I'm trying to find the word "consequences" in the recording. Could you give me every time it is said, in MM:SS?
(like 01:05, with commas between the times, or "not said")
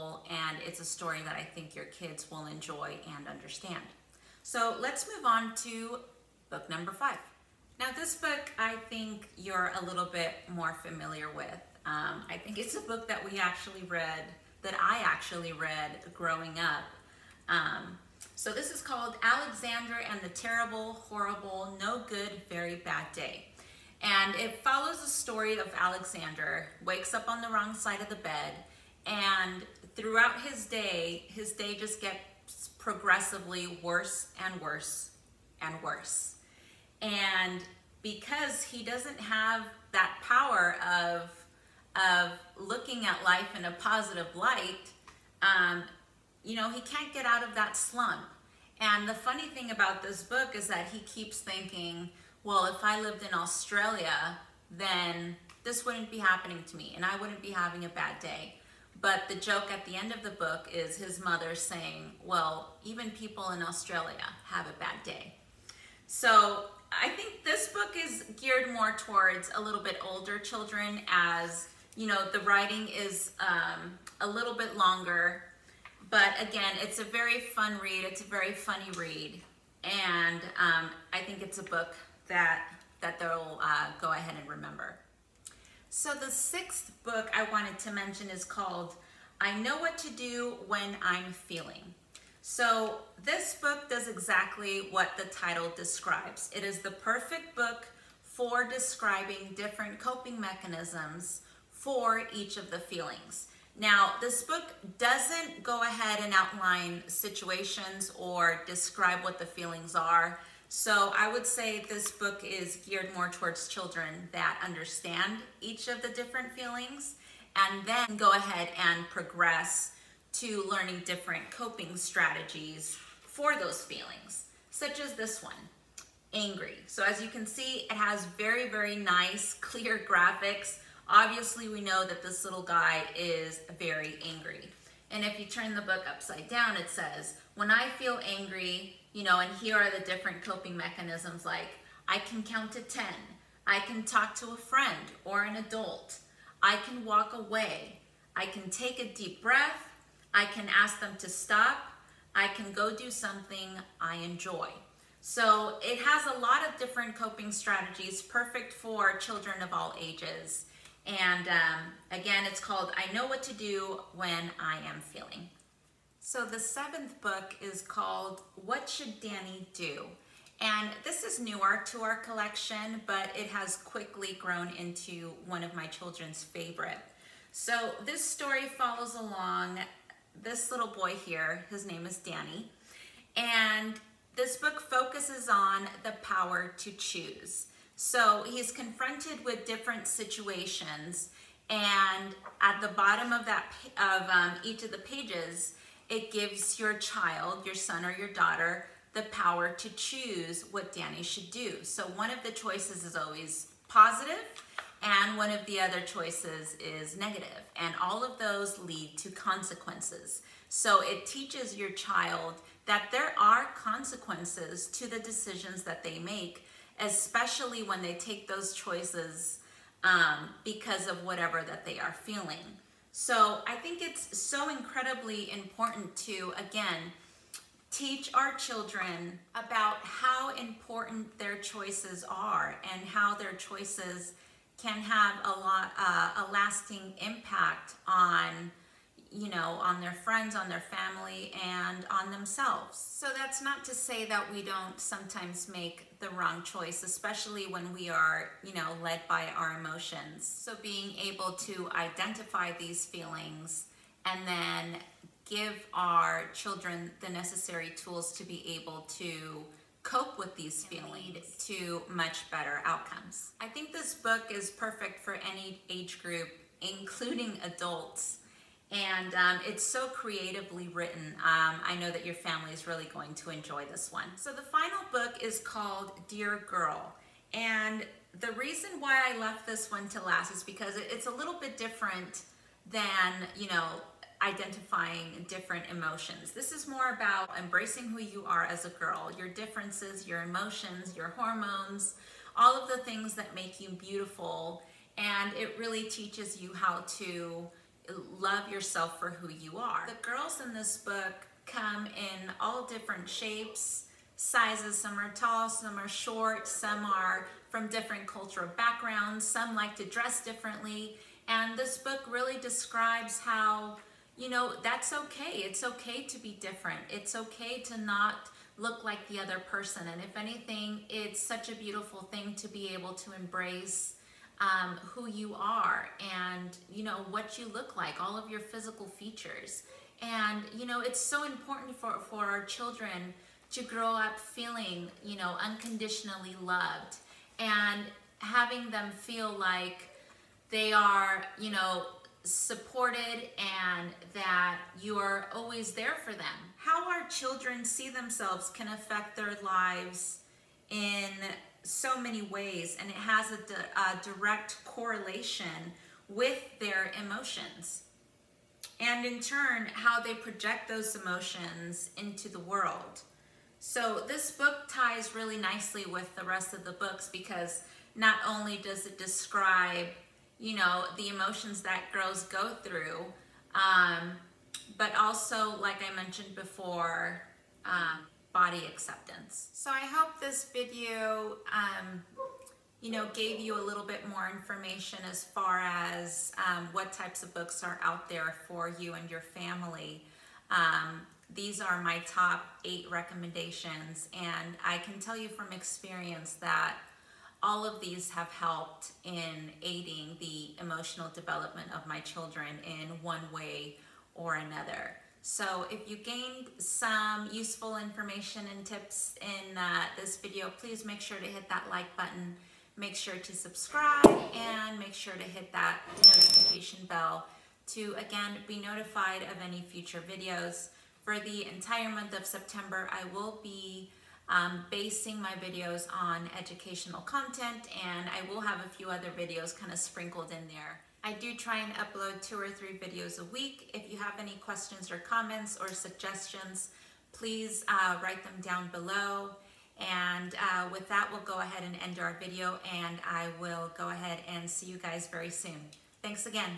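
03:29, 03:33.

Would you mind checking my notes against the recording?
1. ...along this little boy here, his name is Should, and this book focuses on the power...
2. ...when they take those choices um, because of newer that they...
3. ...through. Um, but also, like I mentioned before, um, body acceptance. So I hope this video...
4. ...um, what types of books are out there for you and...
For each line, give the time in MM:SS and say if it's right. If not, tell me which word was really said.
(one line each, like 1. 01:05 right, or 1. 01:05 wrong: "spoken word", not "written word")
1. 02:59 wrong: "Danny", not "Should"
2. 03:37 wrong: "whatever", not "newer"
3. 06:12 right
4. 06:26 right.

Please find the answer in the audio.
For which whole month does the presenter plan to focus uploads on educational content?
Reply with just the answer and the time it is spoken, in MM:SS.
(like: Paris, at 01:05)
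September, at 07:02.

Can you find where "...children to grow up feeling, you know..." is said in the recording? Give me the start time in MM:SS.
05:32.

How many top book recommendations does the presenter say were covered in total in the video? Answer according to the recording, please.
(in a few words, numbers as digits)
8.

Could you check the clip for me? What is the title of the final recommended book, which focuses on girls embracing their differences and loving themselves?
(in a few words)
Dear Girl.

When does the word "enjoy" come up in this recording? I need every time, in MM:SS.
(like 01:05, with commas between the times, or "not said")
00:02, 02:34, 04:33.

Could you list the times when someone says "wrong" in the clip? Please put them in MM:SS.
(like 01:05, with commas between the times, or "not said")
00:27, 04:06.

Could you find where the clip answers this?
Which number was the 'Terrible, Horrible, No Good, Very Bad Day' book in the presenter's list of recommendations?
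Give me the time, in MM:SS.
00:06.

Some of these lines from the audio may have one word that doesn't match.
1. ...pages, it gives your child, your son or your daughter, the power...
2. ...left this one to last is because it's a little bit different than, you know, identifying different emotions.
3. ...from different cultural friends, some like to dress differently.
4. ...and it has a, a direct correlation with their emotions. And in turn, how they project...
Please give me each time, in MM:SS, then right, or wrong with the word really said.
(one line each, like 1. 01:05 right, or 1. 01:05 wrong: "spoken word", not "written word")
1. 03:14 right
2. 04:39 right
3. 05:07 wrong: "backgrounds", not "friends"
4. 05:52 right.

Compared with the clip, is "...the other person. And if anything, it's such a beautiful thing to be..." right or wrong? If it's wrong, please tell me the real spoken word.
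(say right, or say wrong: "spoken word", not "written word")
right.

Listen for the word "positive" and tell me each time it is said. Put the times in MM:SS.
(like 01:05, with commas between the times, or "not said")
00:43, 03:23.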